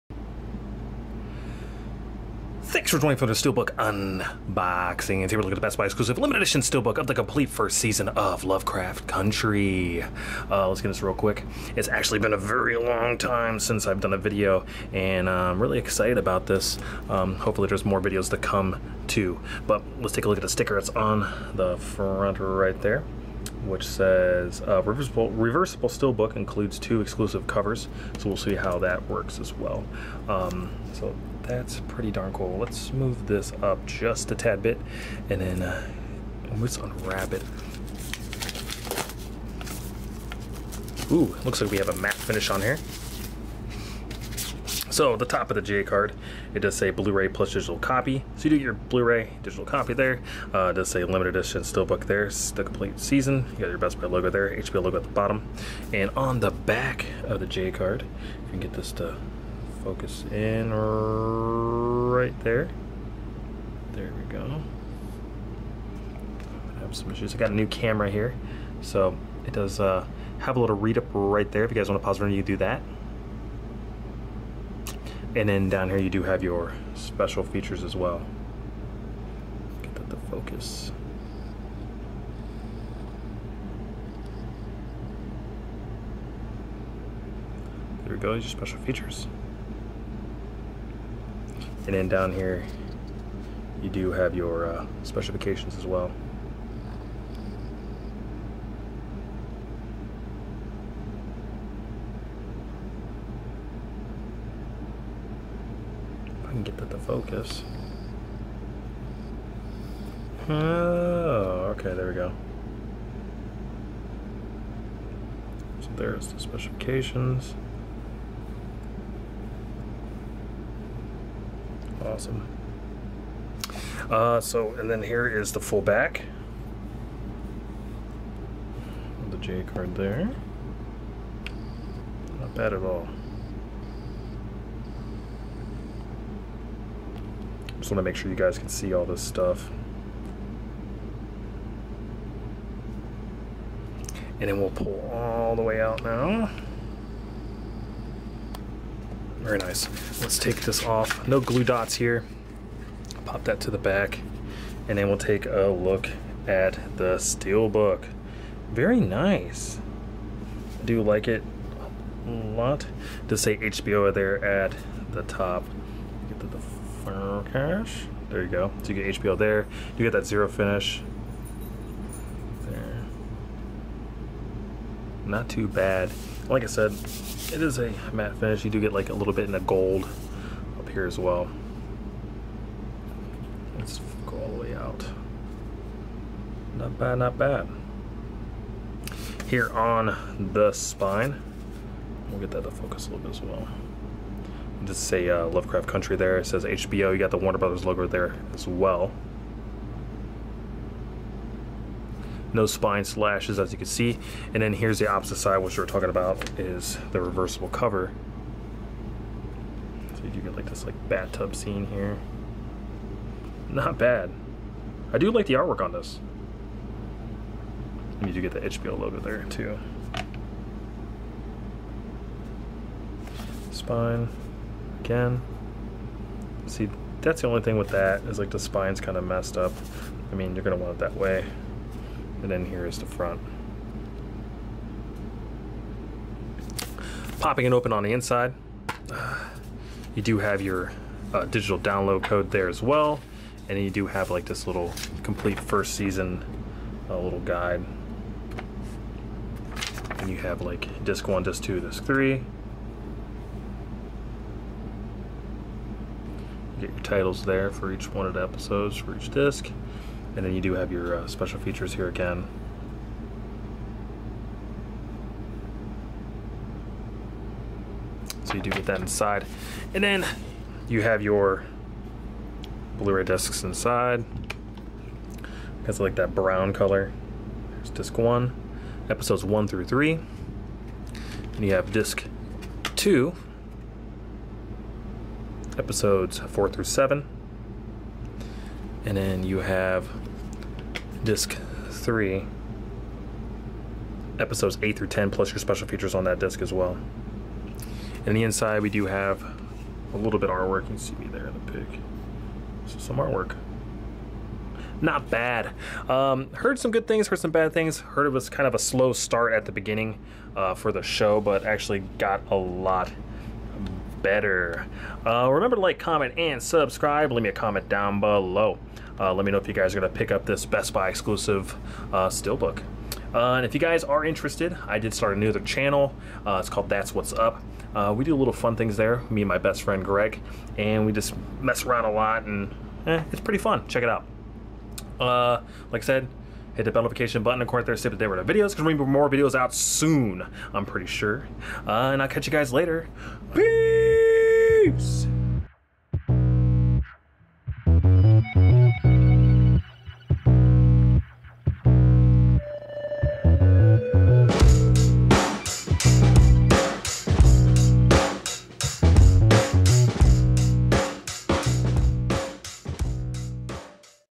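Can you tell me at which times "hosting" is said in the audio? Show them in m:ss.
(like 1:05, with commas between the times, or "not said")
not said.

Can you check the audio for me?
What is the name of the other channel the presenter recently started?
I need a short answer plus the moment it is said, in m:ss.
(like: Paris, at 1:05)
That's What's Up, at 5:26.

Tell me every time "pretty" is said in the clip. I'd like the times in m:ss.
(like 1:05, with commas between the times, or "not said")
0:31, 5:33, 5:40.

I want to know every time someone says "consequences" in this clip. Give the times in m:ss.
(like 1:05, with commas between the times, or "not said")
not said.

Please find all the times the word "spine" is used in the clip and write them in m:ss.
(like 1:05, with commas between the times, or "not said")
3:10, 3:22, 3:43, 3:48.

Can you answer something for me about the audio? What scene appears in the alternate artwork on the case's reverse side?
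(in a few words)
Bathtub scene.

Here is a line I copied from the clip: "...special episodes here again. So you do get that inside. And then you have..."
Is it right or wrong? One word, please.
wrong.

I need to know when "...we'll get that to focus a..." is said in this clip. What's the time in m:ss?
3:12.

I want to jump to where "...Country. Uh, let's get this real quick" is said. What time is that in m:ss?
0:09.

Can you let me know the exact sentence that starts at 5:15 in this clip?
Uh, remember to like, comment, and subscribe.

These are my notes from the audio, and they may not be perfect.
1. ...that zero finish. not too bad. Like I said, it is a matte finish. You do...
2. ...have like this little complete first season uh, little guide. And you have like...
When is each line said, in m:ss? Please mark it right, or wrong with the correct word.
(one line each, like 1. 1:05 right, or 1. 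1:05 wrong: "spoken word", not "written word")
1. 2:50 right
2. 4:04 right.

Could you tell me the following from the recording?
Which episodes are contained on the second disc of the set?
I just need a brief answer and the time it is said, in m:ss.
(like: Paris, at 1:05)
Episodes 4 through 7, at 4:45.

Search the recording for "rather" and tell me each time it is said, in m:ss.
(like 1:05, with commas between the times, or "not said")
not said.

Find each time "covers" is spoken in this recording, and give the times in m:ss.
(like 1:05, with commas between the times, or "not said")
0:27, 3:27.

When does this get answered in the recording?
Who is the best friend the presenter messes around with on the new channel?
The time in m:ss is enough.
5:30.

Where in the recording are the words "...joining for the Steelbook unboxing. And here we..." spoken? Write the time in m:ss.
0:02.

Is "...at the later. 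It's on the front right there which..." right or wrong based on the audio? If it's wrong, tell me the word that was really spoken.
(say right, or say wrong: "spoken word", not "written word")
wrong: "sticker", not "later".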